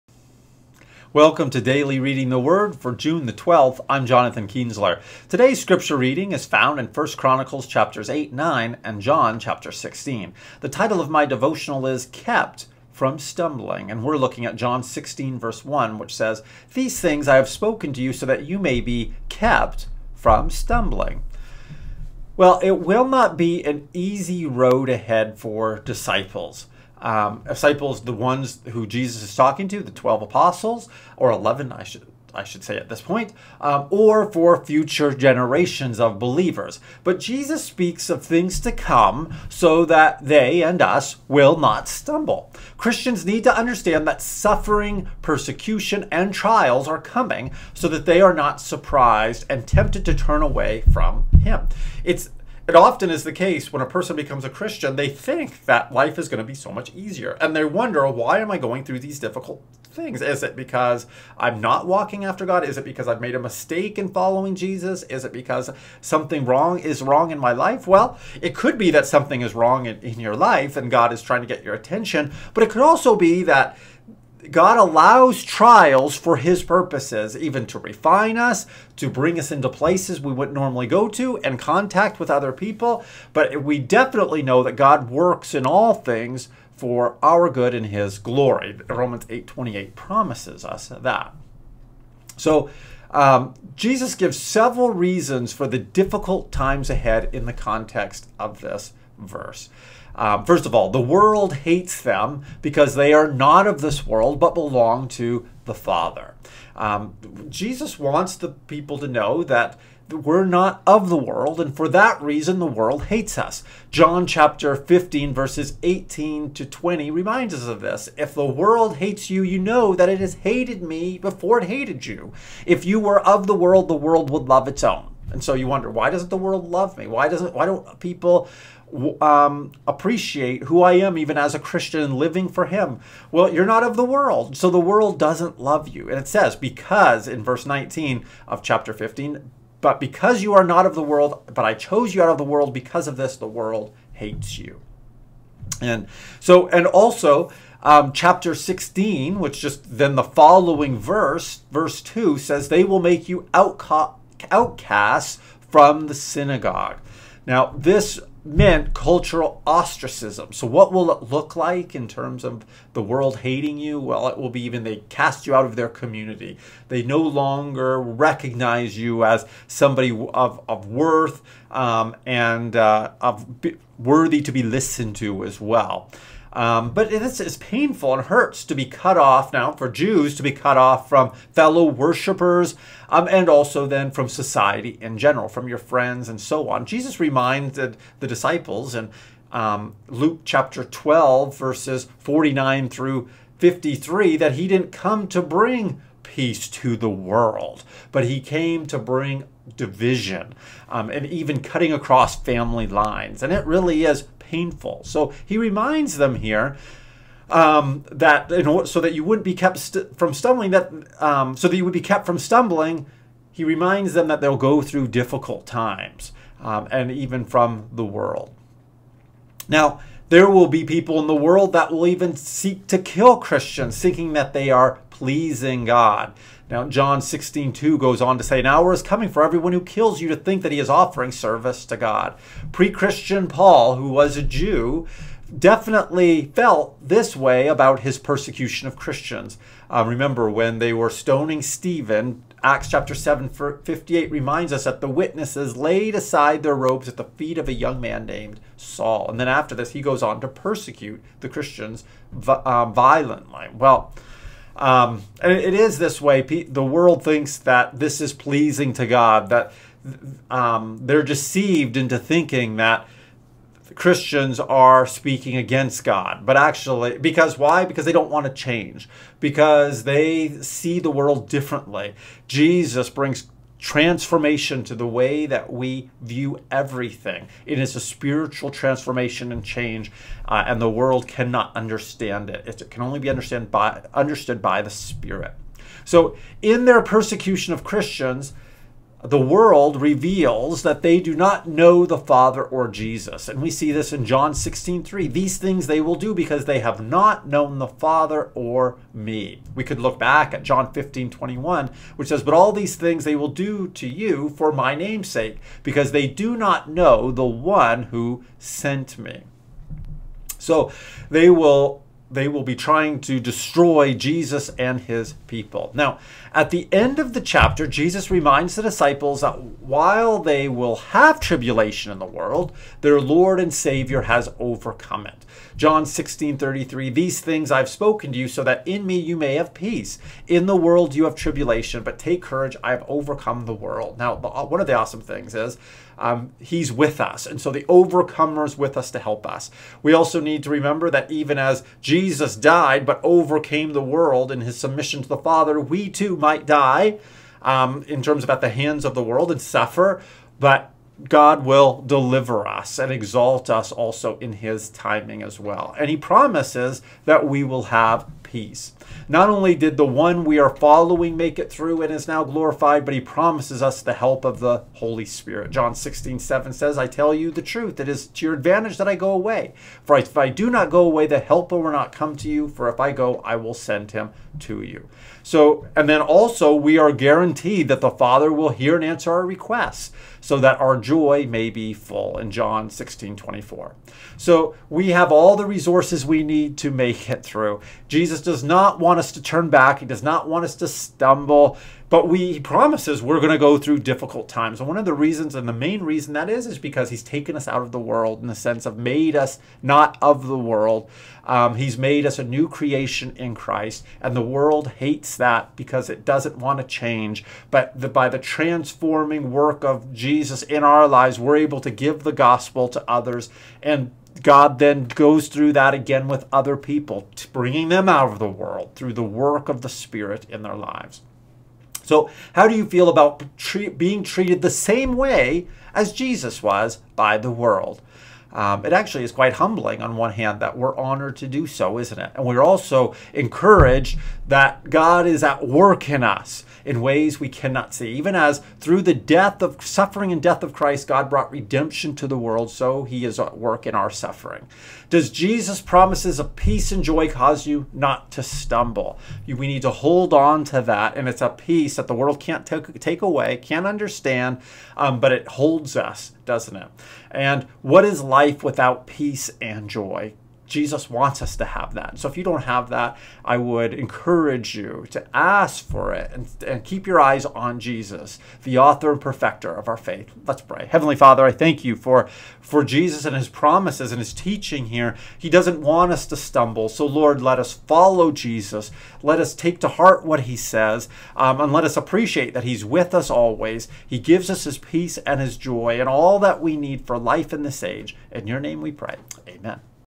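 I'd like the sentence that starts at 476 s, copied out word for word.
So, Lord, let us follow Jesus.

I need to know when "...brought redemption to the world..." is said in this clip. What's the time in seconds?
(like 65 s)
441 s.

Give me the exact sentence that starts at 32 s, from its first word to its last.
I should say at this point, um, or for future generations of believers.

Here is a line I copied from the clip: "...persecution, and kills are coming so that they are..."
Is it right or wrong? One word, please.
wrong.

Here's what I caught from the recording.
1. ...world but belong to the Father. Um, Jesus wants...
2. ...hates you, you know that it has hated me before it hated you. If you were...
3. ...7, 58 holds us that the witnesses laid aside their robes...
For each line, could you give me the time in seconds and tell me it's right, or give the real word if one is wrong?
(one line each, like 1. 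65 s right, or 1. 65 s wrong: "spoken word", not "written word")
1. 104 s right
2. 118 s right
3. 243 s wrong: "reminds", not "holds".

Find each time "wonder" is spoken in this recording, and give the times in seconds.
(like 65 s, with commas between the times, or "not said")
57 s, 125 s.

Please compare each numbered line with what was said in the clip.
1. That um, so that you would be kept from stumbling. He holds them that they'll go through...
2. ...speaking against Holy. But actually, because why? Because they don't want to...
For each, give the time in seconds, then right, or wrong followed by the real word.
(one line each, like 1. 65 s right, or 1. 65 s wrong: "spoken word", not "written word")
1. 210 s wrong: "reminds", not "holds"
2. 265 s wrong: "God", not "Holy".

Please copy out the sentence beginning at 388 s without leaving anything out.
Jesus does not want us to turn back, He does not want us to stumble.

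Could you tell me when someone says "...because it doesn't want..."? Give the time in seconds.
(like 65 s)
405 s.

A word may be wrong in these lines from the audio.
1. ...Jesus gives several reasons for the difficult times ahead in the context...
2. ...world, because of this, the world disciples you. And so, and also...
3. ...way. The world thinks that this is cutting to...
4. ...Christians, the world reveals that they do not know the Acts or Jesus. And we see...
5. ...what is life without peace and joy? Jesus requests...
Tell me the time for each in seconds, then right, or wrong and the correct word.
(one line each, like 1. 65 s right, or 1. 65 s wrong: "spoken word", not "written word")
1. 93 s right
2. 142 s wrong: "hates", not "disciples"
3. 256 s wrong: "pleasing", not "cutting"
4. 287 s wrong: "Father", not "Acts"
5. 457 s wrong: "wants", not "requests".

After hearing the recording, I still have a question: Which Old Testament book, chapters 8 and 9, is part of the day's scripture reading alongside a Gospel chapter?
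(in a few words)
1 Chronicles.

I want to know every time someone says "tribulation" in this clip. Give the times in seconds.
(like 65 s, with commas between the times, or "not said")
321 s, 331 s.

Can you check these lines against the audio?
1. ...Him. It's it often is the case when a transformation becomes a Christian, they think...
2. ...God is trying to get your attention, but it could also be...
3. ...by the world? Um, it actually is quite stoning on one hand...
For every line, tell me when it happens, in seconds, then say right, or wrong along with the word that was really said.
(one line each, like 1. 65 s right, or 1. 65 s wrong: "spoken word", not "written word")
1. 51 s wrong: "person", not "transformation"
2. 70 s right
3. 427 s wrong: "humbling", not "stoning".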